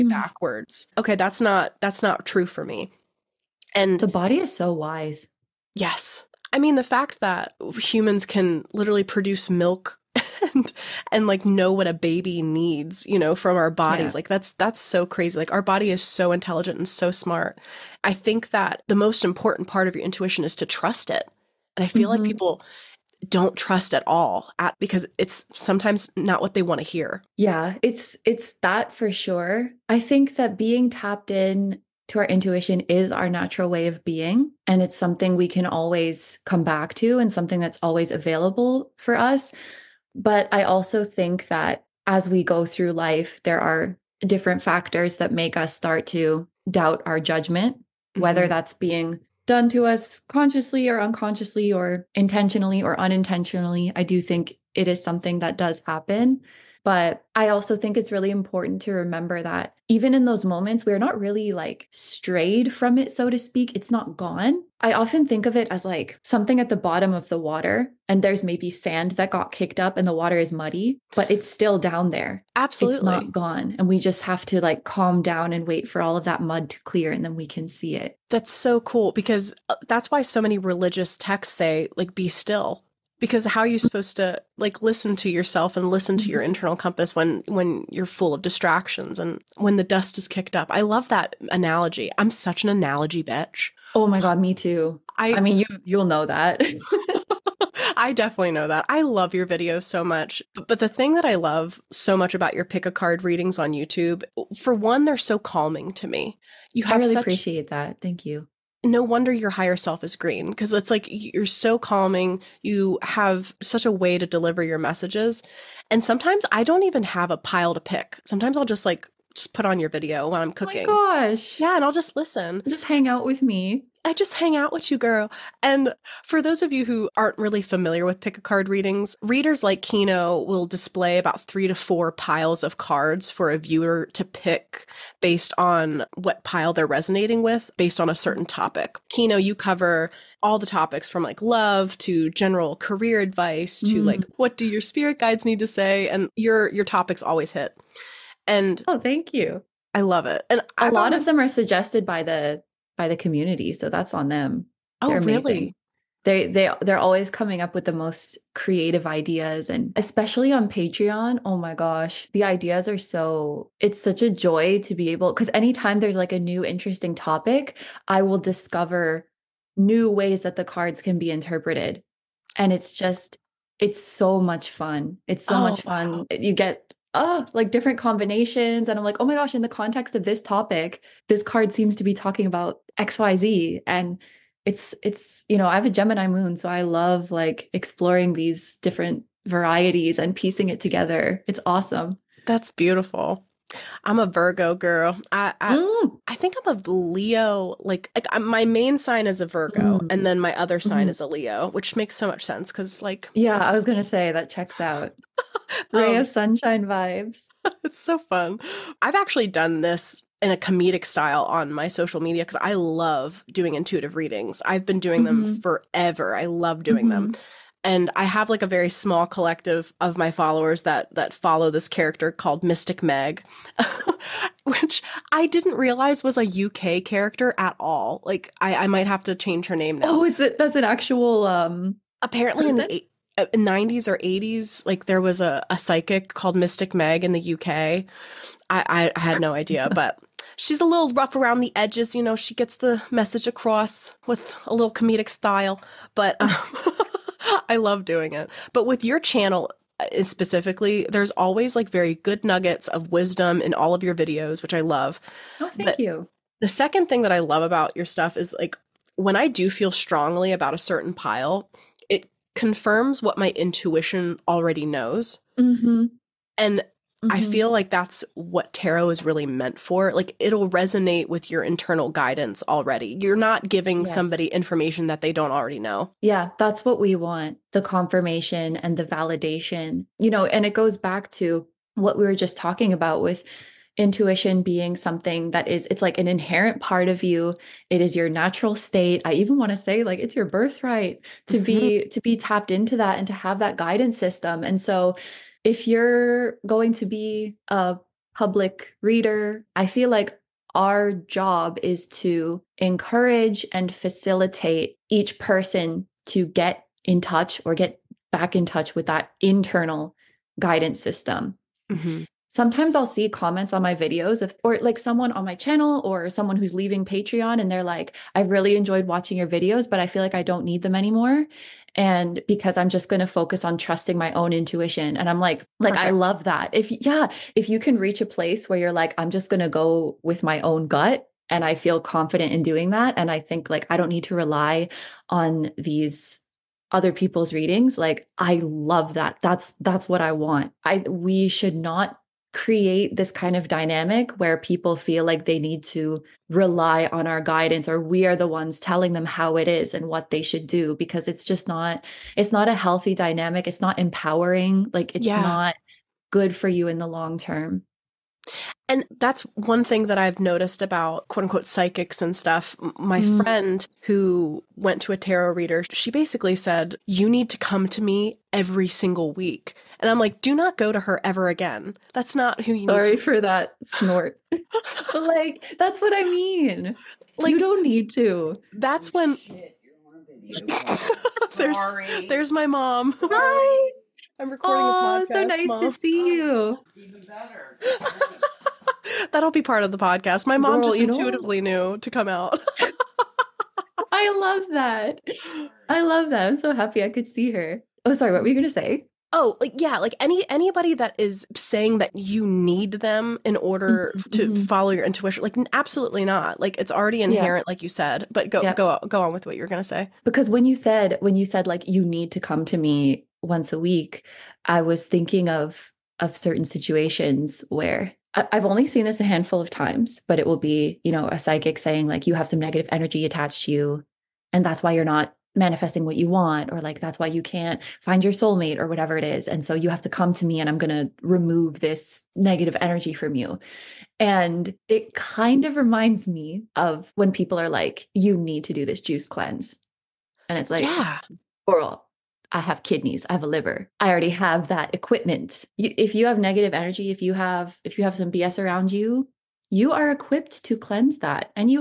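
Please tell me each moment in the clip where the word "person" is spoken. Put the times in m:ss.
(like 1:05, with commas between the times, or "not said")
5:05.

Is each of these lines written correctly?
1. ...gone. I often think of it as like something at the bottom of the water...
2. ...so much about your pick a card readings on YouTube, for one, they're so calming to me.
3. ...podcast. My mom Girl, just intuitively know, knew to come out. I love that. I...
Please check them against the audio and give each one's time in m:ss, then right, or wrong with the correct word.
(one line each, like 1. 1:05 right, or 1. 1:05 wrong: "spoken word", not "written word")
1. 1:04 right
2. 1:41 right
3. 6:29 right.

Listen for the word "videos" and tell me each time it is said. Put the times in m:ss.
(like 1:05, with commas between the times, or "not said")
1:39, 1:59, 4:14, 5:13, 5:19.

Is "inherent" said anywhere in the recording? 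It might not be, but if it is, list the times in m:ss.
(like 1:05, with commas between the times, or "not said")
4:46, 6:47.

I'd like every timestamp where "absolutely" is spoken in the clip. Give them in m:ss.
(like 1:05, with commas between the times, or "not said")
1:12, 6:45.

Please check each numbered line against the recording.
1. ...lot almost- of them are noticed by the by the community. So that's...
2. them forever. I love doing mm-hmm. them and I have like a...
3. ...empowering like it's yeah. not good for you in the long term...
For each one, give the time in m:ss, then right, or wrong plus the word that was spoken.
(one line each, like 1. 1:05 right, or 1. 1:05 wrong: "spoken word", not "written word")
1. 2:30 wrong: "suggested", not "noticed"
2. 3:35 right
3. 5:53 right.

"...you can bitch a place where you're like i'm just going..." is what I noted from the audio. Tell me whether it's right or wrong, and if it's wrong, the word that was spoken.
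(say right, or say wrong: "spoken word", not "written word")
wrong: "reach", not "bitch".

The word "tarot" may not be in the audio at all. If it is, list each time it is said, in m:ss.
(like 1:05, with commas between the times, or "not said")
4:28, 6:05.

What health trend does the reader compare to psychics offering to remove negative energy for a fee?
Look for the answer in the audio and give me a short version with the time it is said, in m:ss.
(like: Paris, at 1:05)
juice cleanse, at 7:18.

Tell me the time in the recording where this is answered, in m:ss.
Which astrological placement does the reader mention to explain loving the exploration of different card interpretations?
3:05.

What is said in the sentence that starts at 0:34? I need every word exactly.
And it's something we can always come back to and something that's always available for us.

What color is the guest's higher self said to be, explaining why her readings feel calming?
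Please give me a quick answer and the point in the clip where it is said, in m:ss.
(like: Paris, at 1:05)
green, at 1:50.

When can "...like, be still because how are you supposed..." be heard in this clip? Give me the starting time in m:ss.
1:21.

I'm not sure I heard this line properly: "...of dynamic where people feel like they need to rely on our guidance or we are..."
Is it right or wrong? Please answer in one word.
right.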